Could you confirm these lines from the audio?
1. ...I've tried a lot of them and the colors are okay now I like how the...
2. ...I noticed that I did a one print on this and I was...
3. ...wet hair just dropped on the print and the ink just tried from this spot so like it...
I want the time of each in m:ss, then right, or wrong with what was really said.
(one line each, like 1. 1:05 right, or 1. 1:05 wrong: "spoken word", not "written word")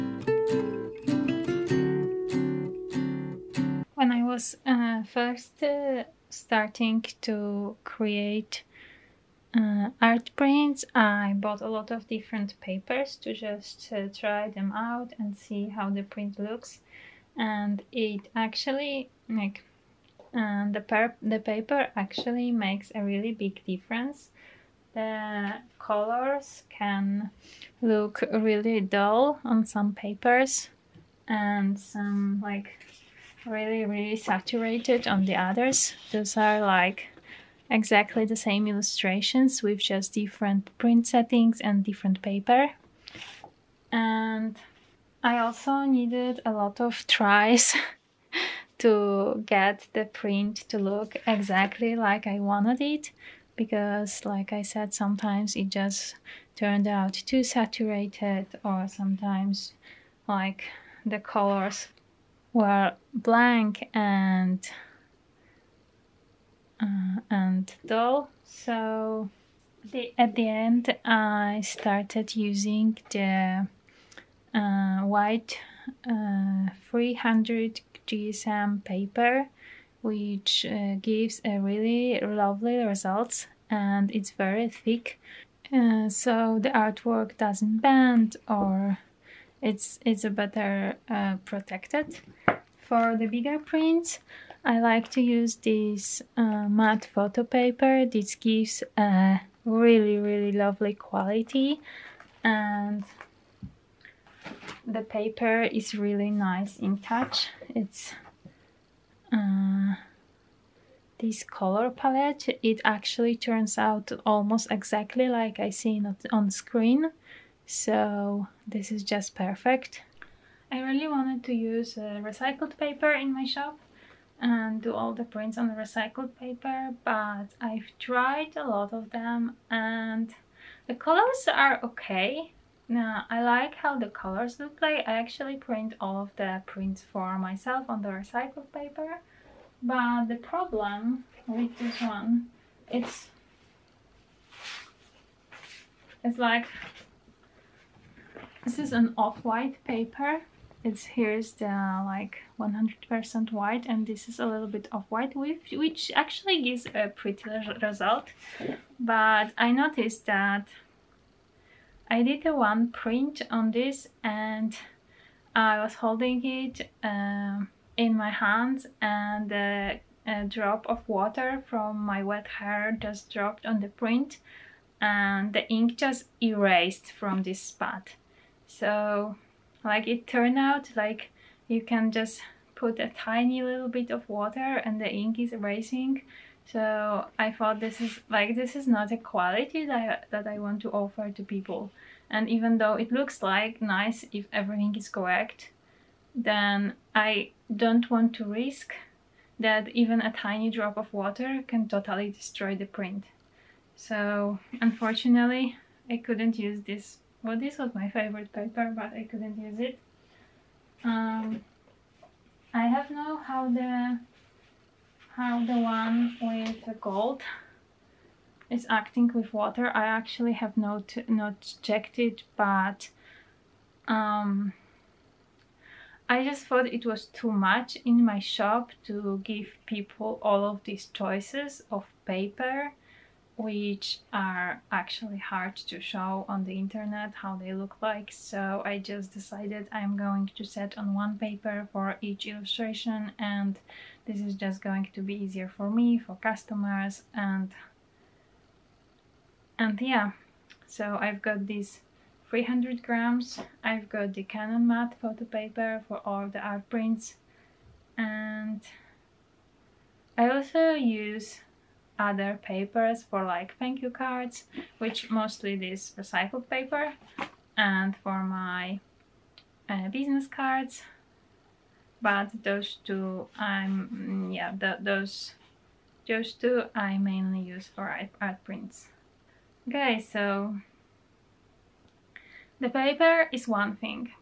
1. 2:07 right
2. 2:39 right
3. 2:52 wrong: "erased", not "tried".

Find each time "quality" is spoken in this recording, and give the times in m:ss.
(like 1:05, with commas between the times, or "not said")
1:40, 3:09.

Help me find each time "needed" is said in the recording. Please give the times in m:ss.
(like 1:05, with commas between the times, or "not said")
0:45.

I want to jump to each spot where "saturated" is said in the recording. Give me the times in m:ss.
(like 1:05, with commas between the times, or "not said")
0:34, 0:57.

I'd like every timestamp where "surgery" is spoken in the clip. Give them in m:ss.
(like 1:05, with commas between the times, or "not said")
not said.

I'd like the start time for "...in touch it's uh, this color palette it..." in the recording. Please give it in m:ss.
1:46.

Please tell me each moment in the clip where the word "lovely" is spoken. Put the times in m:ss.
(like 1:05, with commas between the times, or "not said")
1:22, 1:40.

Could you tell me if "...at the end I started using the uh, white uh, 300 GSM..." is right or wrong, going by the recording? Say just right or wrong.
right.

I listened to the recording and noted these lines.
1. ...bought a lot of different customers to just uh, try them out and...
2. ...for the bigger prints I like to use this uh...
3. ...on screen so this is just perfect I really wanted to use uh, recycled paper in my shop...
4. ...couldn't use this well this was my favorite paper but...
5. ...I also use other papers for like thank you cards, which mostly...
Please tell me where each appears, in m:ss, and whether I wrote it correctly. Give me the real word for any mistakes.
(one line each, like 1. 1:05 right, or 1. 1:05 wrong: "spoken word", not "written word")
1. 0:11 wrong: "papers", not "customers"
2. 1:32 right
3. 1:56 right
4. 3:26 right
5. 4:20 right.